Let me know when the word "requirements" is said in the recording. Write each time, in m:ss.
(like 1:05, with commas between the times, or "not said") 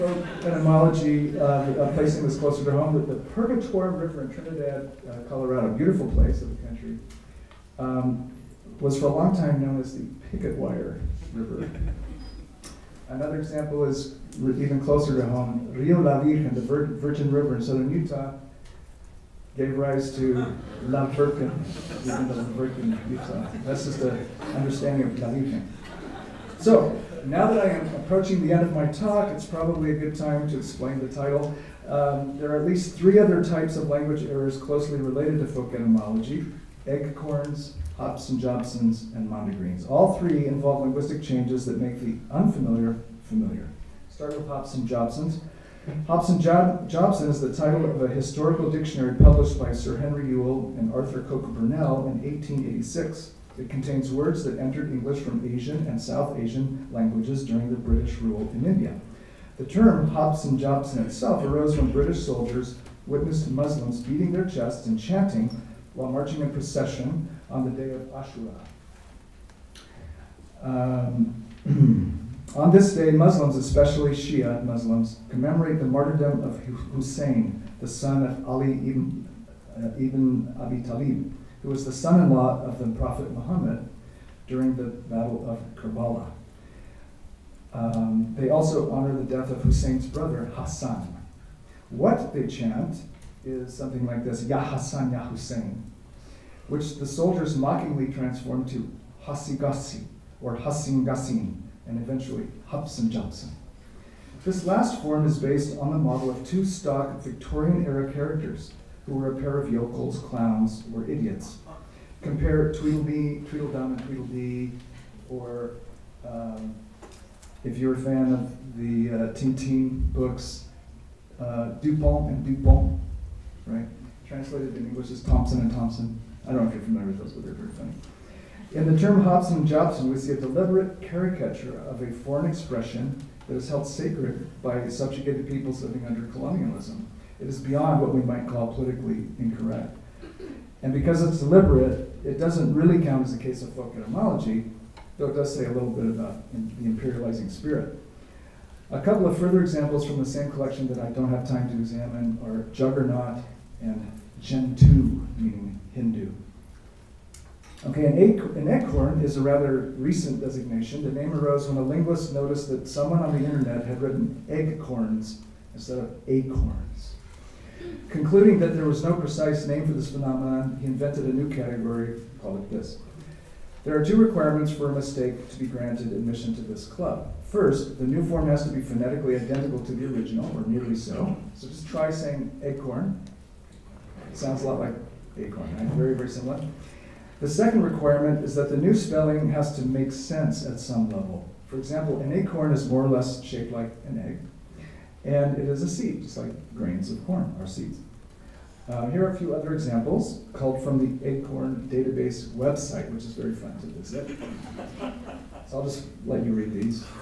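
2:54, 3:07.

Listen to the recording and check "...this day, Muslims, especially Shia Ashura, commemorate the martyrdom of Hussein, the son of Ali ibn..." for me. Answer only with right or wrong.
wrong.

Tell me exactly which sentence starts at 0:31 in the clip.
Um, there are at least three other types of language errors closely related to folk etymology, egg corns, Hobson Jobsons, and Mondegreens.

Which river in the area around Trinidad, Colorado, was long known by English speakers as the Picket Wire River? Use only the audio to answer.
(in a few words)
Purgatorium River.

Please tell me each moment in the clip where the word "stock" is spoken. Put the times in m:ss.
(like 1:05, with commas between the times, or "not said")
1:46.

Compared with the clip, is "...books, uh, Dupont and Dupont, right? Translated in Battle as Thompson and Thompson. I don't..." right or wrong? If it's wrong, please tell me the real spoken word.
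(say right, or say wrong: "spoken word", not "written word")
wrong: "English", not "Battle".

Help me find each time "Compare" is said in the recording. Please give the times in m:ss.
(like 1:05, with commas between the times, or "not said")
1:52.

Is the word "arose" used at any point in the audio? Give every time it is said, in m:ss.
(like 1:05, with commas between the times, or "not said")
1:01, 2:41.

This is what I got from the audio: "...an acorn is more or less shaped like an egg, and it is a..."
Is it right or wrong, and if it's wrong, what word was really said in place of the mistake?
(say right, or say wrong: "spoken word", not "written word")
right.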